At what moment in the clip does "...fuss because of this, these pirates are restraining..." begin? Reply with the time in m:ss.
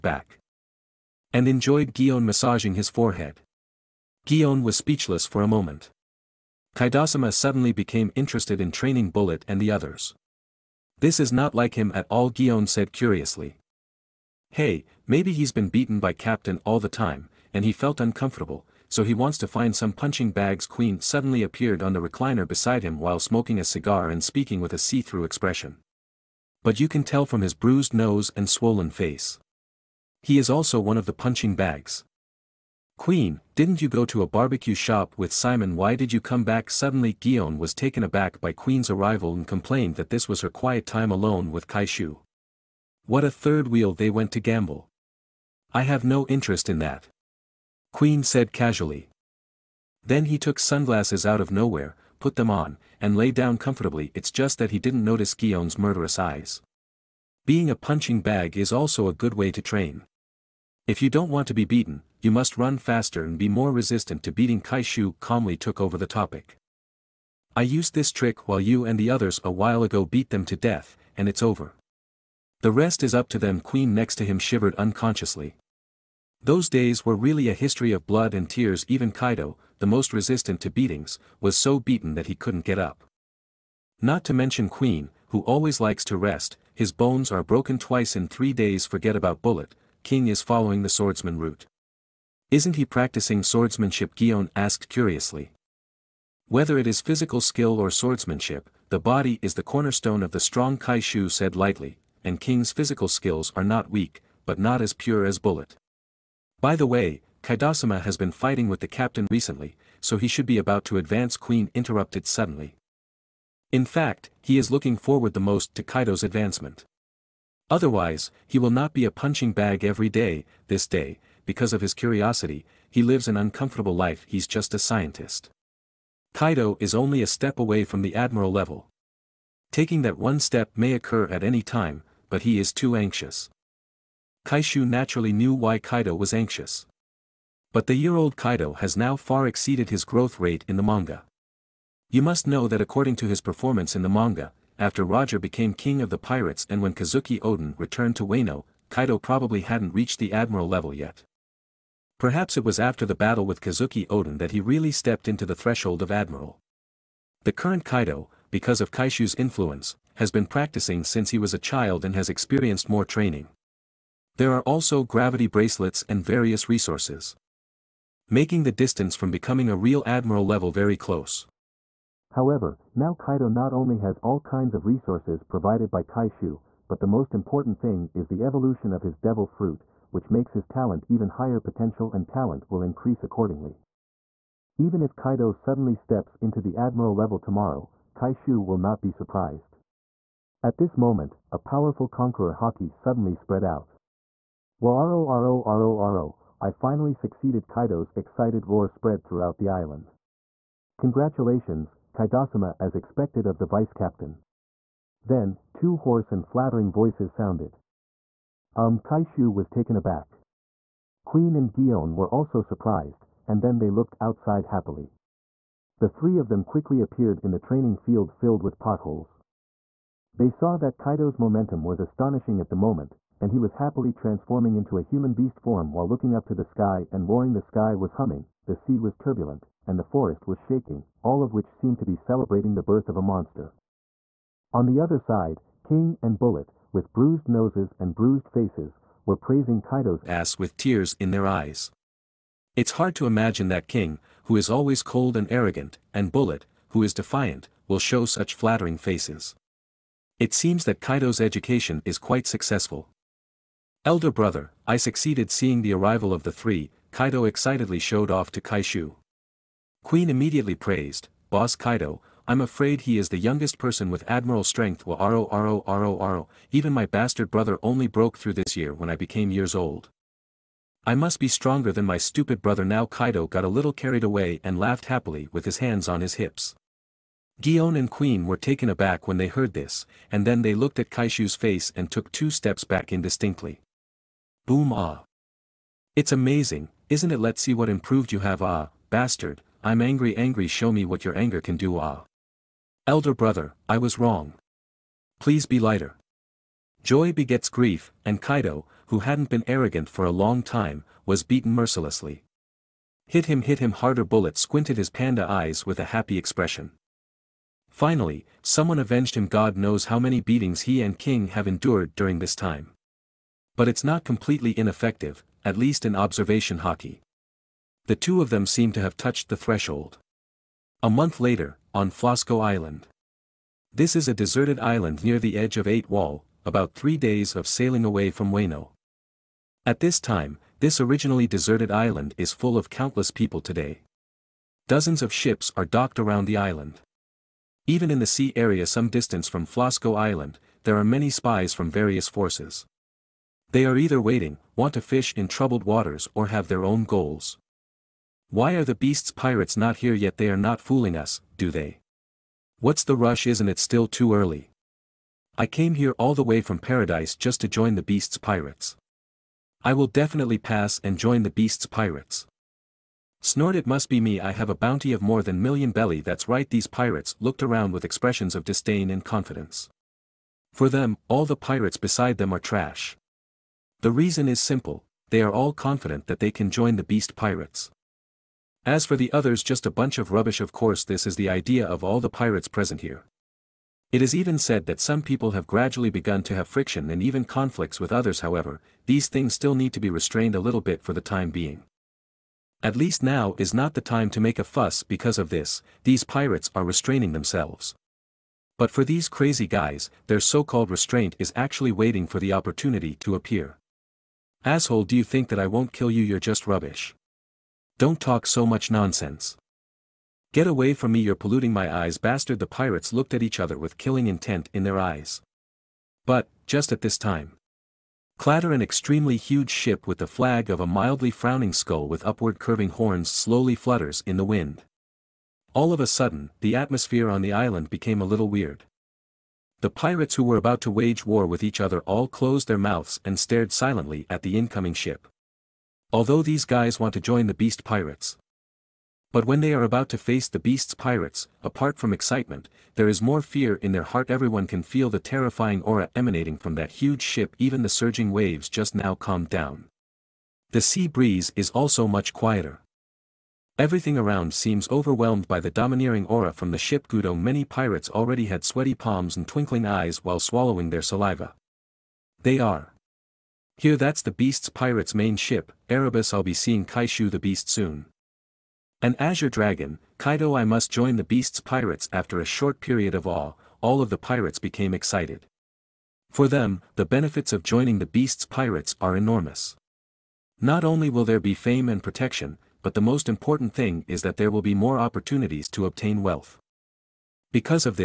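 6:34.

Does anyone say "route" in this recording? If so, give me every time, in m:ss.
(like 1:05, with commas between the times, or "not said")
1:31.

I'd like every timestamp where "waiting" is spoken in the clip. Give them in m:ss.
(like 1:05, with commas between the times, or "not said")
5:44, 6:41.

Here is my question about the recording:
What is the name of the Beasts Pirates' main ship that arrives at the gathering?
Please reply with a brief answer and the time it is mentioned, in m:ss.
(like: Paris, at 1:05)
Erebus, at 7:45.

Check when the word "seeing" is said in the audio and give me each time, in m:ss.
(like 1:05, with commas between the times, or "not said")
4:15, 7:46.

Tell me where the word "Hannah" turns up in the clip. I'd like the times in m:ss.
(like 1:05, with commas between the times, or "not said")
not said.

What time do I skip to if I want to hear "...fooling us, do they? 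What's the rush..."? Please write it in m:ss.
5:50.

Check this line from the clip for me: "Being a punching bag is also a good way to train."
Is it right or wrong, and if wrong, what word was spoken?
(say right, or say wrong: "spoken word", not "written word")
right.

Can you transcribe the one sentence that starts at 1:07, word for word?
I used this trick while you and the others a while ago beat them to death, and it's over.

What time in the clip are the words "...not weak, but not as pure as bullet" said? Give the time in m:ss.
1:43.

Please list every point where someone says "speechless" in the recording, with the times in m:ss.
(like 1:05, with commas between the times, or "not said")
0:04.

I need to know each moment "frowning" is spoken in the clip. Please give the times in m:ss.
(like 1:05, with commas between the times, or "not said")
7:01.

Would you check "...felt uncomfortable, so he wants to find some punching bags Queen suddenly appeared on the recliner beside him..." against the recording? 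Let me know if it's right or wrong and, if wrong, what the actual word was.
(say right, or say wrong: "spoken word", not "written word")
right.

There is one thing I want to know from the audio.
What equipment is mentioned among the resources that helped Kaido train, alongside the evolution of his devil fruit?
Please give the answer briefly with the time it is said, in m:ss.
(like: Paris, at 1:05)
Gravity bracelets, at 2:45.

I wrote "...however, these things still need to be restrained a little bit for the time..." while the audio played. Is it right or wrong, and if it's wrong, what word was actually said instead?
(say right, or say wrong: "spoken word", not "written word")
right.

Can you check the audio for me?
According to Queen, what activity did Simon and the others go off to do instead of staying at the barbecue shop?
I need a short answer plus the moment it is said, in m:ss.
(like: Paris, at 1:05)
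Gamble, at 0:44.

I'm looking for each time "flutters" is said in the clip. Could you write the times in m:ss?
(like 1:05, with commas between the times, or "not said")
7:03.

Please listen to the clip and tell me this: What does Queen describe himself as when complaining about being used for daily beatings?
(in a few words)
A scientist.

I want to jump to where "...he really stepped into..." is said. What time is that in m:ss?
2:34.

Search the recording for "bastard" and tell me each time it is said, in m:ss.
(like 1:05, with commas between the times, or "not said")
4:27, 4:49, 6:52.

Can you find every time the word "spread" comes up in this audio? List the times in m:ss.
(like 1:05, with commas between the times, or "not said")
3:13, 3:18.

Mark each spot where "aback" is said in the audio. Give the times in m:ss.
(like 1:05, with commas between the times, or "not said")
0:38, 3:29, 4:38.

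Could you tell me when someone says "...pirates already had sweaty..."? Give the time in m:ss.
7:37.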